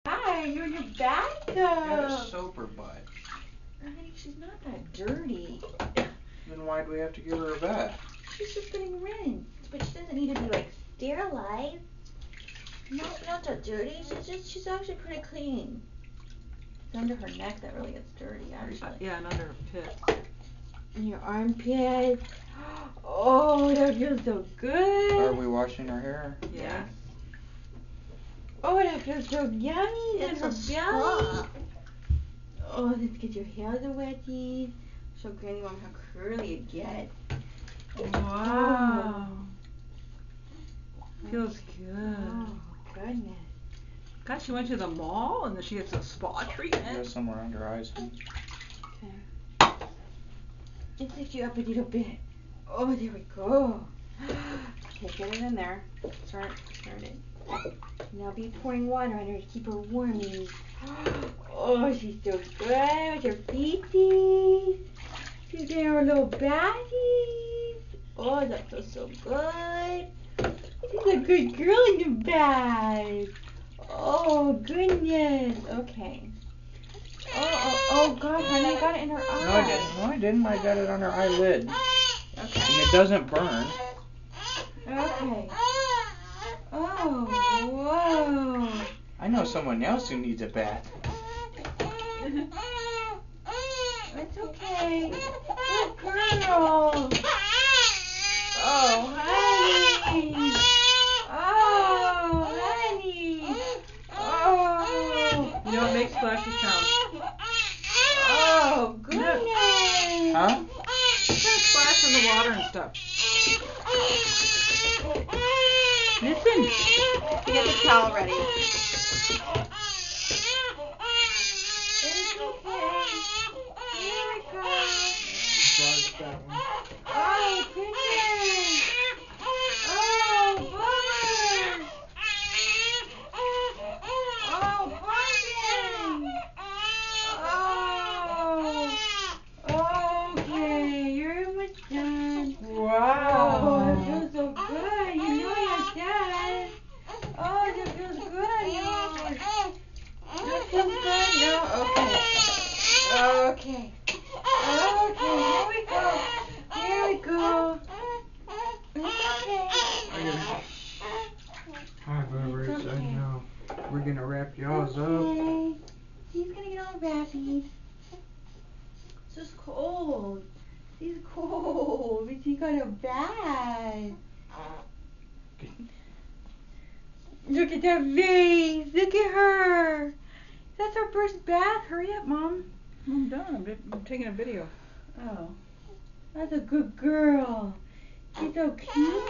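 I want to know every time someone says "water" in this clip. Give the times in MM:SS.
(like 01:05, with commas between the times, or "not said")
00:58, 01:52.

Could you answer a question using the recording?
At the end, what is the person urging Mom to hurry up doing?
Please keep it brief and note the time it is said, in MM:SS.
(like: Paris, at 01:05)
taking a video, at 03:04.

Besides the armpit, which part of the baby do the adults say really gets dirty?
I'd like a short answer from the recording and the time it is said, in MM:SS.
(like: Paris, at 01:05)
under her neck, at 00:17.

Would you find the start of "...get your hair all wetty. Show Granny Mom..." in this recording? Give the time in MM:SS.
00:33.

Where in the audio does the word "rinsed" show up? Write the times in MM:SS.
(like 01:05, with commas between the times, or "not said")
00:09.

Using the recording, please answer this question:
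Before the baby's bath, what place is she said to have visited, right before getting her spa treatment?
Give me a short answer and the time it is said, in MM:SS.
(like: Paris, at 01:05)
the mall, at 00:44.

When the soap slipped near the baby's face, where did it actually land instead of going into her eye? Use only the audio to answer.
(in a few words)
her eyelid.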